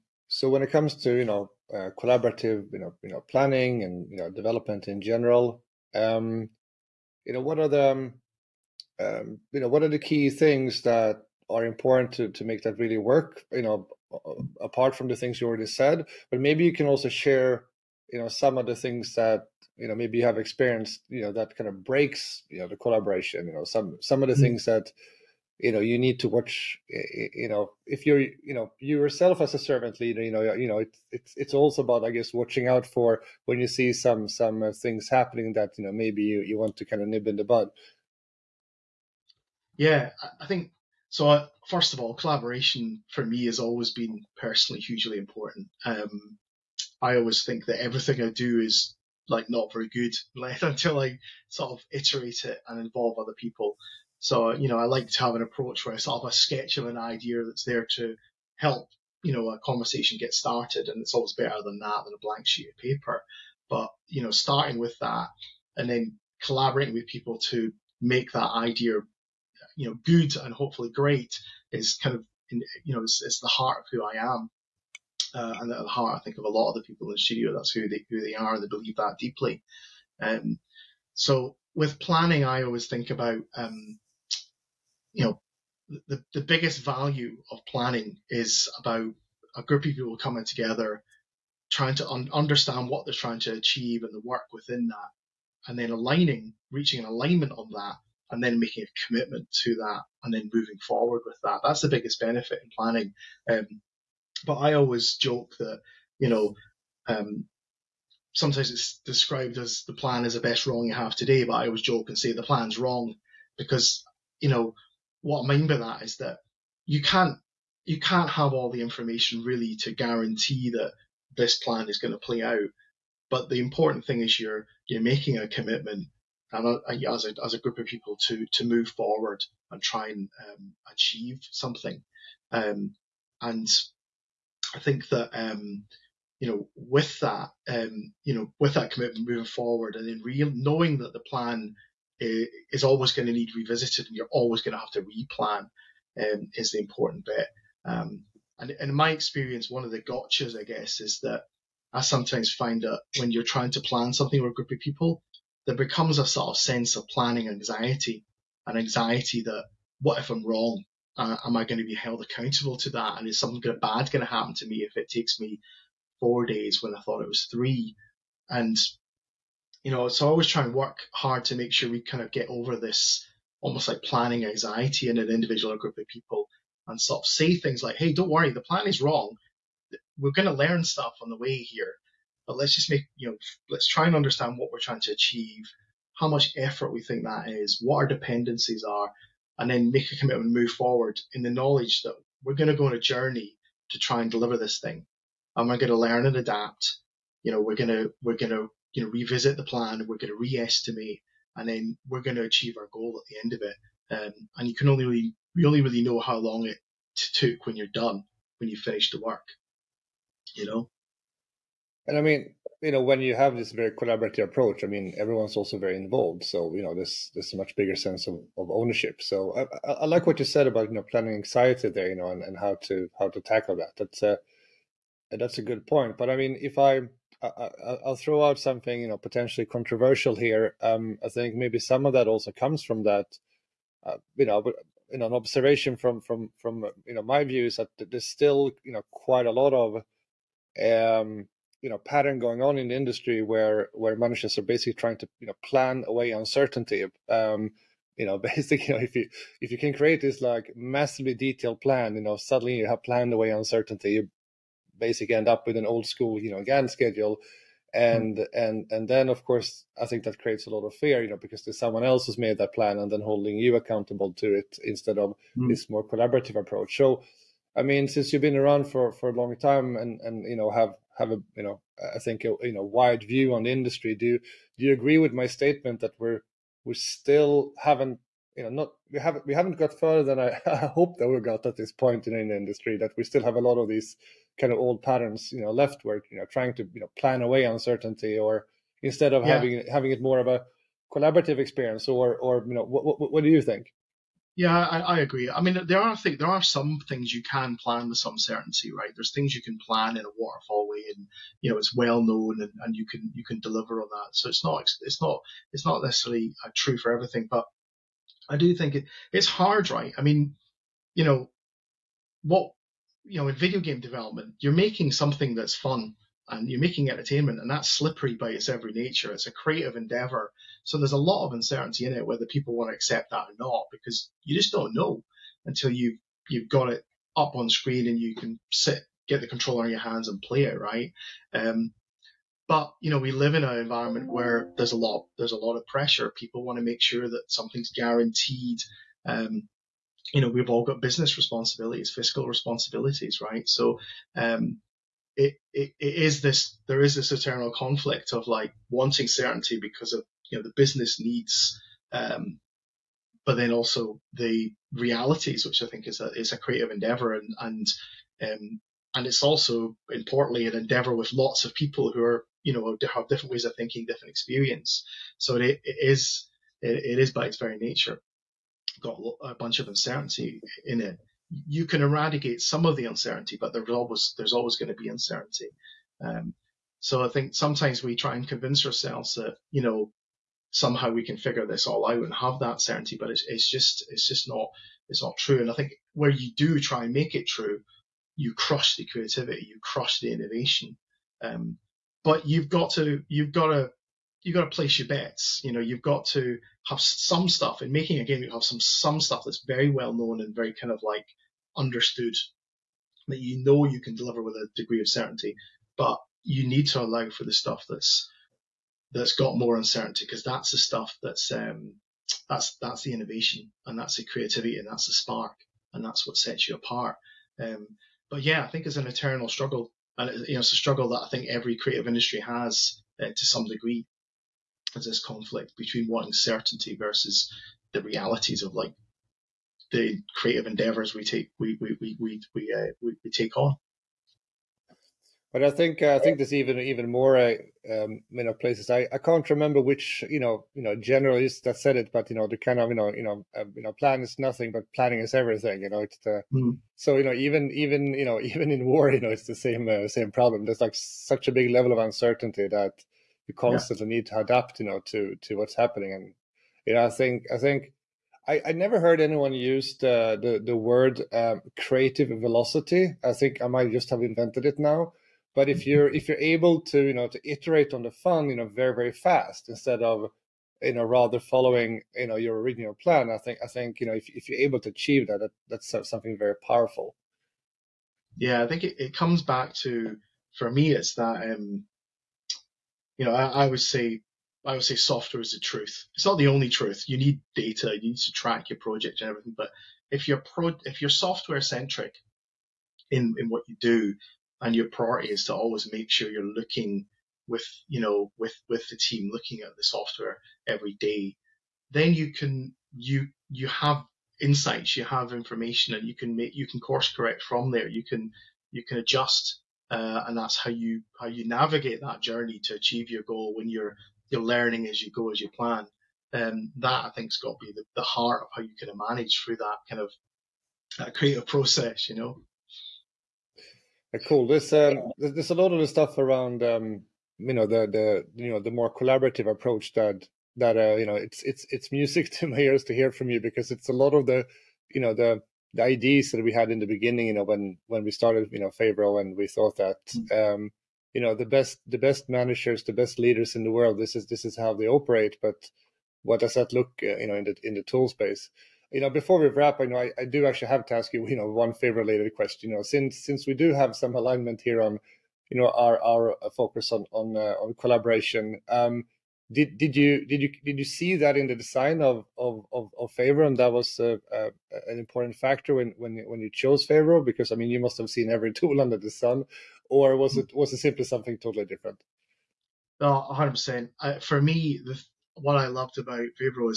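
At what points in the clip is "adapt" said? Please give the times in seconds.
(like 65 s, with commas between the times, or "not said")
196 s, 454 s.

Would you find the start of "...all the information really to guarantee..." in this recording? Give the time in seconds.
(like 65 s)
118 s.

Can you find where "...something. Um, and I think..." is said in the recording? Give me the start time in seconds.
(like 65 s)
131 s.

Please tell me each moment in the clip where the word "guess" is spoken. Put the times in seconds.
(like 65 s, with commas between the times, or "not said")
32 s, 150 s.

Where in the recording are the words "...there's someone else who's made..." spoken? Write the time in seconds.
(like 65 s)
261 s.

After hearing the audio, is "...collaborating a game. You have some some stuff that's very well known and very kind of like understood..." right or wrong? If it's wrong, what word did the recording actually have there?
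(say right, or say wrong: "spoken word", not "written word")
wrong: "making", not "collaborating".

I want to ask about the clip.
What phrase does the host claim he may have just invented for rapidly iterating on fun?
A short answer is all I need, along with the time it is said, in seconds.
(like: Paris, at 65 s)
Creative velocity, at 461 s.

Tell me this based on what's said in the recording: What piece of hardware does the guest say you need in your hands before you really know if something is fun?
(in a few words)
The controller.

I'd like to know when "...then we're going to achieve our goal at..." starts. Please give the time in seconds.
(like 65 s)
201 s.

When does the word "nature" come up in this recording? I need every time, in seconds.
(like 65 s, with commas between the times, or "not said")
318 s, 367 s.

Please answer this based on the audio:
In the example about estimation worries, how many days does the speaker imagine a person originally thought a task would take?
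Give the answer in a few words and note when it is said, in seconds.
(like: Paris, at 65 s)
3, at 167 s.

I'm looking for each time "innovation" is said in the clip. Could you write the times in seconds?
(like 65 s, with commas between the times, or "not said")
390 s, 413 s.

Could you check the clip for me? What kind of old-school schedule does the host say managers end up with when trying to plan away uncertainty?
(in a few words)
Gantt schedule.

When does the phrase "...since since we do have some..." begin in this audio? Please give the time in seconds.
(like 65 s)
552 s.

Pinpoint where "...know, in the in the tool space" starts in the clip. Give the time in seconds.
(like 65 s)
547 s.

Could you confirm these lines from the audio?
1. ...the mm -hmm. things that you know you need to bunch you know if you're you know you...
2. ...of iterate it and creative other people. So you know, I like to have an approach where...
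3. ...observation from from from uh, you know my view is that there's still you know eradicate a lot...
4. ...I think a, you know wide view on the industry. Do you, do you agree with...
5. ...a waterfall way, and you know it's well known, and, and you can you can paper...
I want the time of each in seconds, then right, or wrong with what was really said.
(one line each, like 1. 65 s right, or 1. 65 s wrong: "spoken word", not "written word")
1. 24 s wrong: "watch", not "bunch"
2. 51 s wrong: "involve", not "creative"
3. 235 s wrong: "quite", not "eradicate"
4. 272 s right
5. 300 s wrong: "deliver", not "paper".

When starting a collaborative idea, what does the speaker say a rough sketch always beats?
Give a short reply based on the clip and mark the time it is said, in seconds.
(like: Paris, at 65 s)
A blank sheet of paper, at 62 s.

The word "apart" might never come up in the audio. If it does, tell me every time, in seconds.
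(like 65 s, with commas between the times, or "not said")
14 s, 416 s.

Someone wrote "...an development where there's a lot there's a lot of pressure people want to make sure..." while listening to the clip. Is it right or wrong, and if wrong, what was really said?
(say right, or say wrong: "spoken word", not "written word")
wrong: "environment", not "development".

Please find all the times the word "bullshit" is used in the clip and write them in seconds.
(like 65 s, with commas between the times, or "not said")
not said.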